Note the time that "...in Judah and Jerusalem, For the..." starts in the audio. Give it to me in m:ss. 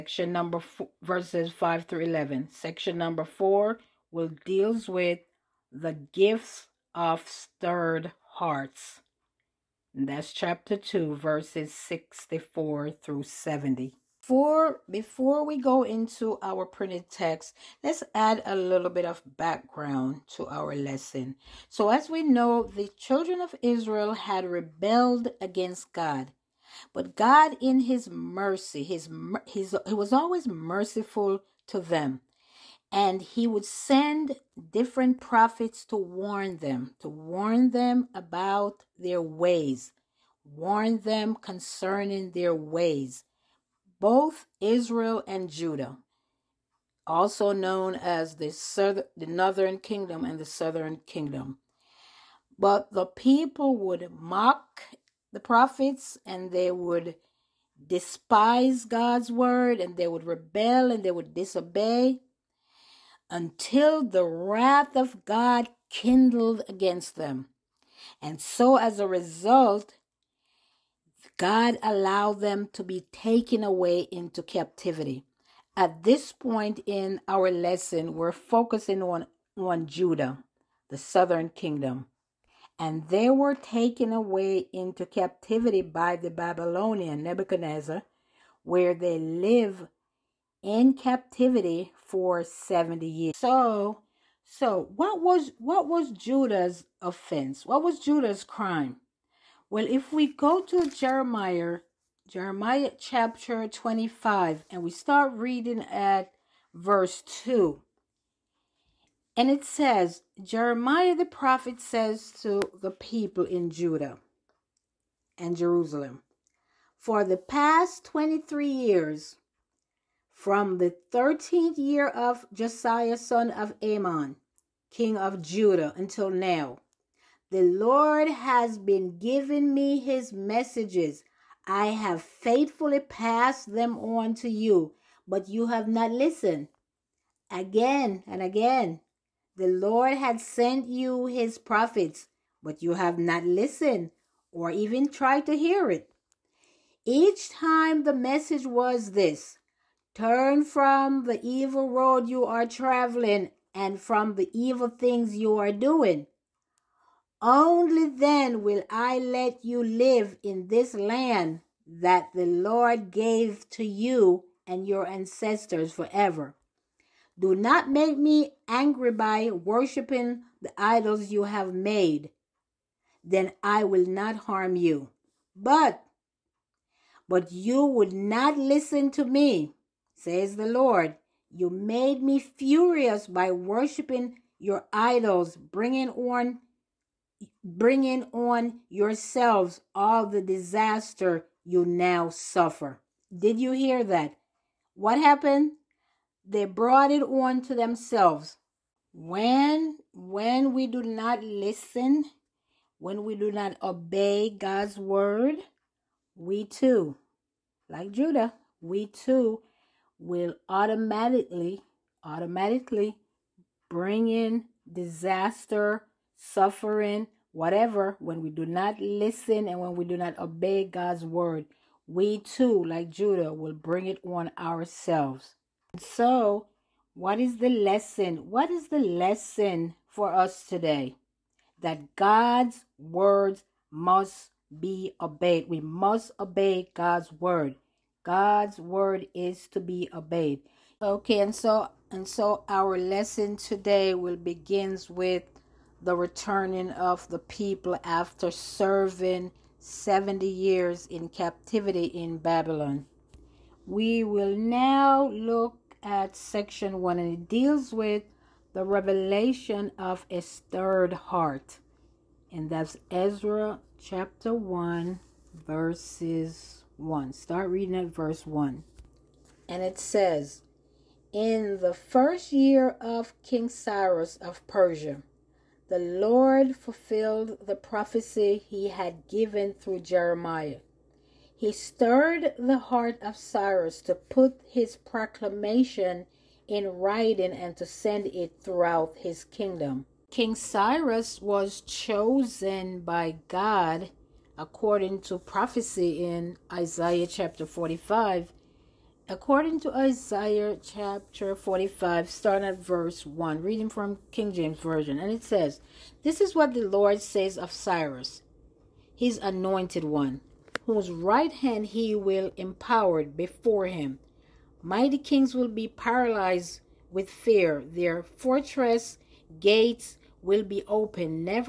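1:53.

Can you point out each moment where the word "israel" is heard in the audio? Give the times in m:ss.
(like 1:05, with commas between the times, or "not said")
0:23, 0:44.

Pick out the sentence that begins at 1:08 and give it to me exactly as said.
And so, as a result, God allowed them to be taken away into captivity.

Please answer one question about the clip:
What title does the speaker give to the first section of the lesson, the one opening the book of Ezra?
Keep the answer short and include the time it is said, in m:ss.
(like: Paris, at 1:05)
The revelation of a stirred heart, at 4:18.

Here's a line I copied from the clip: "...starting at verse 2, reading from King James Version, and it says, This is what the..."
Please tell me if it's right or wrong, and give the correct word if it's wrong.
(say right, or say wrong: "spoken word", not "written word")
wrong: "1", not "2".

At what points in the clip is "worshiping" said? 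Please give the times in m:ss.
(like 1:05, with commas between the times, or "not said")
2:49, 3:03.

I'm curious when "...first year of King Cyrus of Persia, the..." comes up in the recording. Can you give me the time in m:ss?
4:31.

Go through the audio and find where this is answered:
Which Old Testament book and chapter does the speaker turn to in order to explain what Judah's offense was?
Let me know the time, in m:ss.
1:42.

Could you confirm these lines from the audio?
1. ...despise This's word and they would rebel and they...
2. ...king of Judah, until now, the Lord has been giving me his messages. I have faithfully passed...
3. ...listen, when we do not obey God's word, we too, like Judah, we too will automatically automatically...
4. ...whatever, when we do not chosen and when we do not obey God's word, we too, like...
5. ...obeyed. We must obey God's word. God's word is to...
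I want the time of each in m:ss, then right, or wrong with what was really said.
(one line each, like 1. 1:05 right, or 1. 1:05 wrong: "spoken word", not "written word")
1. 0:57 wrong: "God", not "This"
2. 2:04 right
3. 3:21 right
4. 3:37 wrong: "listen", not "chosen"
5. 3:55 right.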